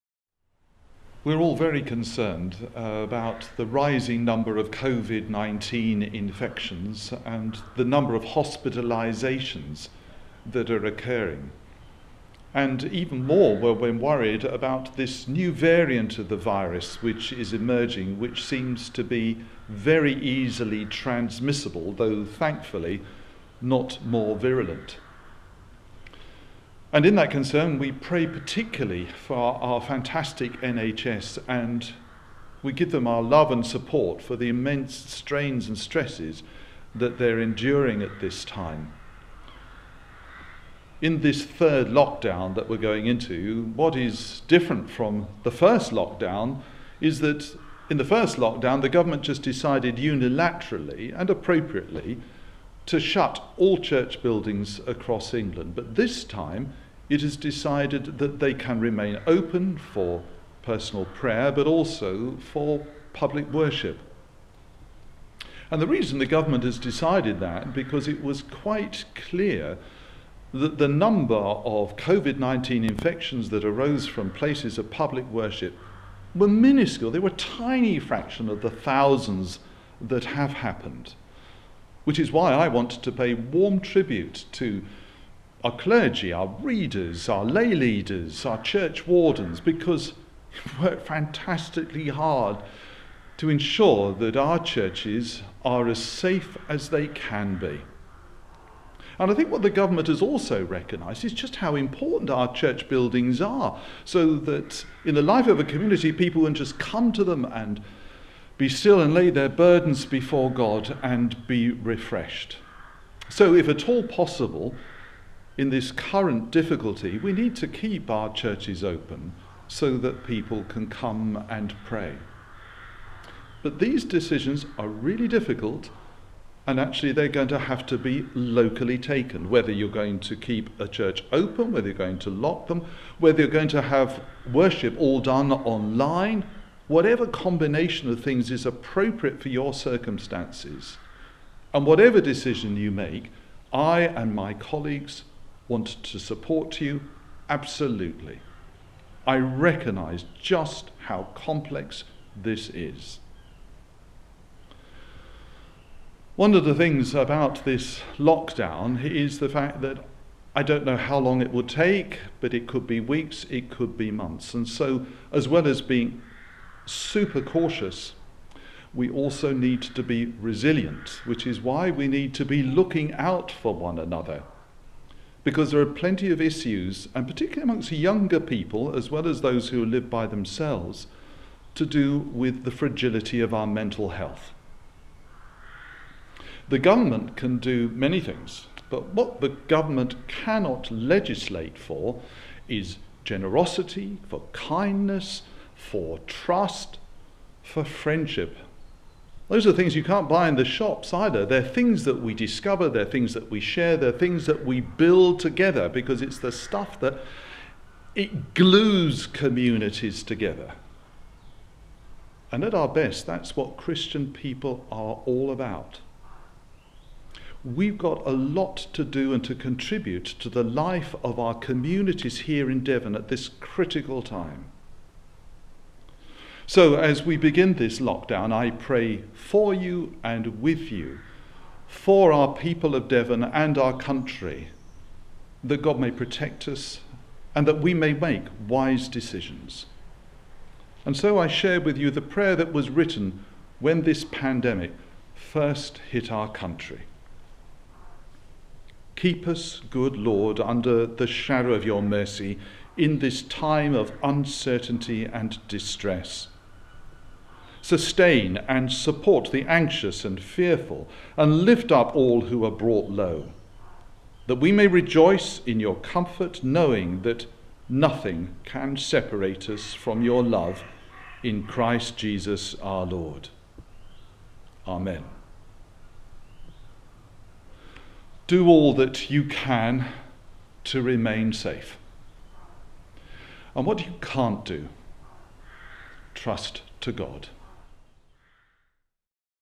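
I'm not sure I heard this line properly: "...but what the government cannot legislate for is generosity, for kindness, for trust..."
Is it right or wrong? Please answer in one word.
right.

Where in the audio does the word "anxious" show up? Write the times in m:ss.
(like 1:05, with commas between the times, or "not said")
4:19.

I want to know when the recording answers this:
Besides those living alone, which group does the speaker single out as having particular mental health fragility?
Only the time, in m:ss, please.
2:57.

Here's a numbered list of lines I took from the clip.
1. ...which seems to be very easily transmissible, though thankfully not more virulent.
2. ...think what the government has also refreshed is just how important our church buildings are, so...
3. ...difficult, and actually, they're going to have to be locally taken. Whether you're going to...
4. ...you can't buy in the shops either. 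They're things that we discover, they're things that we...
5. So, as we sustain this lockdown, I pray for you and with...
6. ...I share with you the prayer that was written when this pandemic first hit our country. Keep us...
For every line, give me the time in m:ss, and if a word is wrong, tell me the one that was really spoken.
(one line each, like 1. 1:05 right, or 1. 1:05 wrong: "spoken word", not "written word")
1. 0:18 right
2. 1:39 wrong: "recognised", not "refreshed"
3. 2:05 right
4. 3:19 right
5. 3:46 wrong: "begin", not "sustain"
6. 4:01 right.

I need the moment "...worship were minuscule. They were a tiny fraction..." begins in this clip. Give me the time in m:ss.
1:15.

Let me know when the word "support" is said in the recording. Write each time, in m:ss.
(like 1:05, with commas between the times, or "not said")
0:33, 2:26, 4:18.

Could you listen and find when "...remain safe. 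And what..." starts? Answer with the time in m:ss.
4:41.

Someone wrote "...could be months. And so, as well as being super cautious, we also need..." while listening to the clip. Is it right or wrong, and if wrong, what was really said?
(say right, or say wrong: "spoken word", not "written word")
right.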